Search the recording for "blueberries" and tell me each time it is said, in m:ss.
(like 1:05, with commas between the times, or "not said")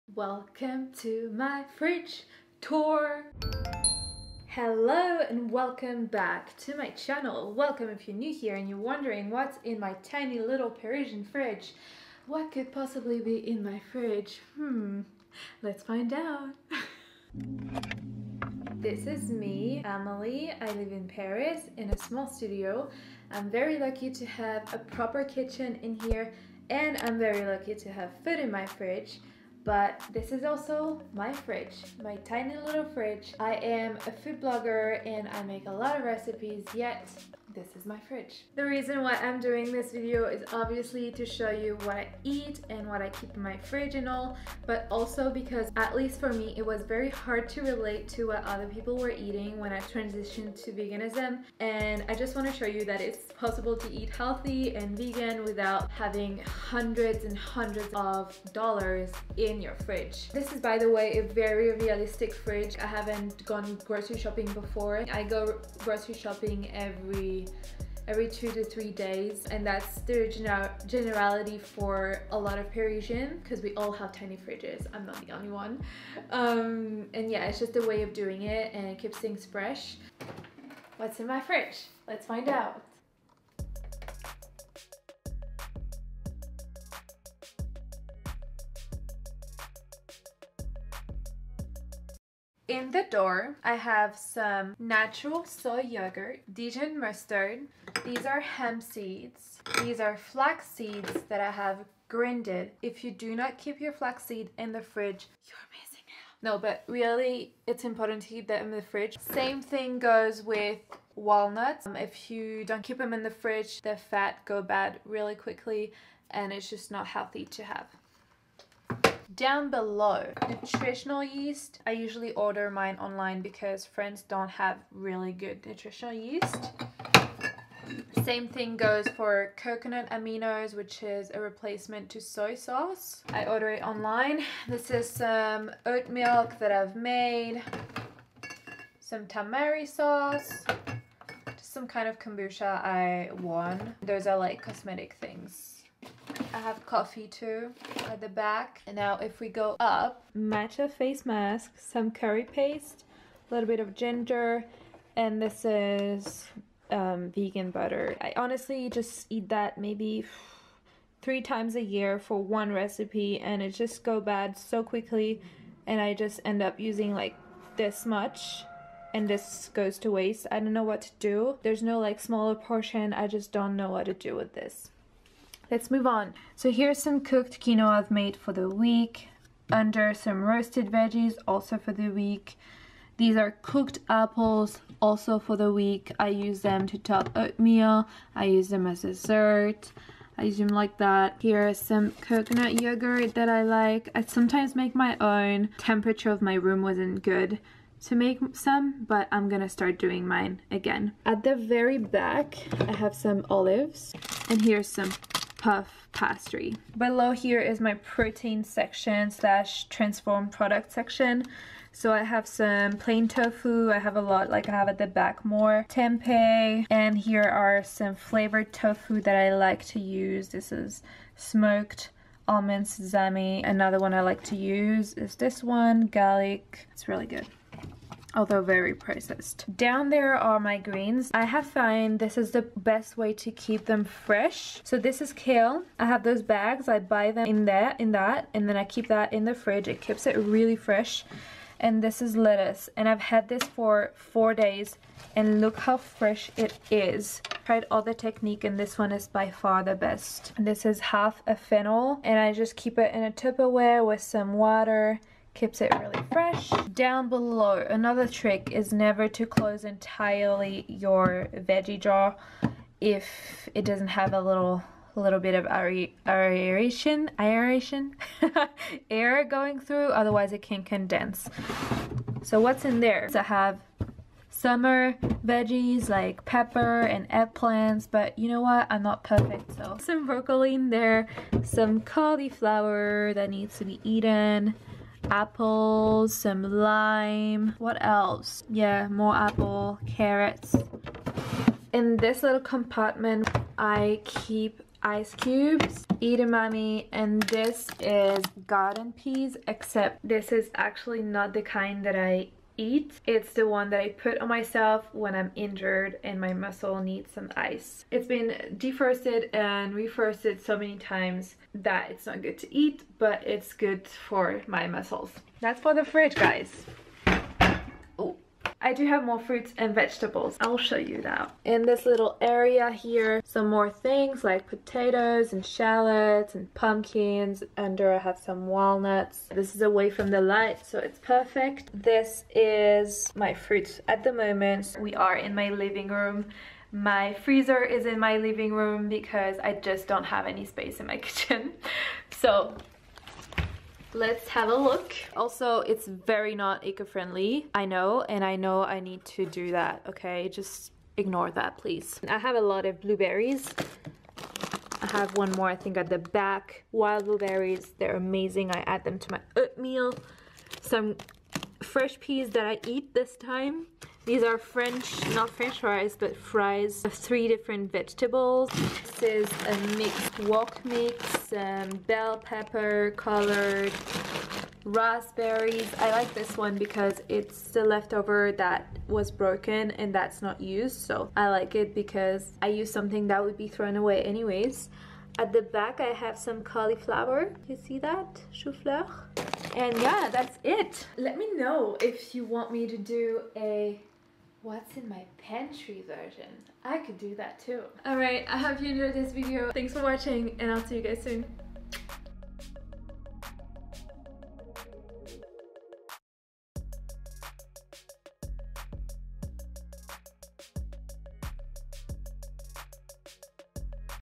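5:52, 5:57.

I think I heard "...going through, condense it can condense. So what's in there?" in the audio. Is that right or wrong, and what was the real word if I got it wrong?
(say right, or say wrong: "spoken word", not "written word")
wrong: "otherwise", not "condense".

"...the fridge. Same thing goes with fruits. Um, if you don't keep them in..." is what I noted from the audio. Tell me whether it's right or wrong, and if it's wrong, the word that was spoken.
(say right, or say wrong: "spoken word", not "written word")
wrong: "walnuts", not "fruits".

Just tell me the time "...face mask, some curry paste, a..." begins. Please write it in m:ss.
2:30.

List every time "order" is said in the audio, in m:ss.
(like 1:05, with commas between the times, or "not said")
2:02, 2:13.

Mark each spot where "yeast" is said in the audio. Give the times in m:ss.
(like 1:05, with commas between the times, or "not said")
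2:01, 2:06.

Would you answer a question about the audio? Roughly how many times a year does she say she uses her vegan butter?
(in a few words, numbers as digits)
3 times.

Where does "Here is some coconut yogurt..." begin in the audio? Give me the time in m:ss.
3:11.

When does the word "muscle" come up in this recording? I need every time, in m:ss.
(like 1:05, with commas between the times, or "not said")
5:06, 5:14.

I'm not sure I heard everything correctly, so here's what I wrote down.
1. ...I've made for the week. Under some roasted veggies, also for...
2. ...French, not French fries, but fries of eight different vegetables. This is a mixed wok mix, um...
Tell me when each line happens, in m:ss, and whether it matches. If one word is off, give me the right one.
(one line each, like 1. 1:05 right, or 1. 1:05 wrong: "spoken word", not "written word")
1. 2:57 right
2. 6:04 wrong: "three", not "eight".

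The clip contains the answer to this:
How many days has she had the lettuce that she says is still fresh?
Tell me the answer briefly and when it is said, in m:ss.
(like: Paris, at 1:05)
4 days, at 4:04.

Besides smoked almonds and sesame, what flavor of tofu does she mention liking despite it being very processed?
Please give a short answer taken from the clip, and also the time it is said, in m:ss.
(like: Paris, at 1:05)
garlic, at 3:46.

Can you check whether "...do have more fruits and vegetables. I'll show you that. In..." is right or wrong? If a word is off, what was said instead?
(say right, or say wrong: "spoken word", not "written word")
right.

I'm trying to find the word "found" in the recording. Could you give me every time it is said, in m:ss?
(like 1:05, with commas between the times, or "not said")
3:51.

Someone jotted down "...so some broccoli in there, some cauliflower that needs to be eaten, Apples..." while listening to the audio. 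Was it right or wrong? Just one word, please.
right.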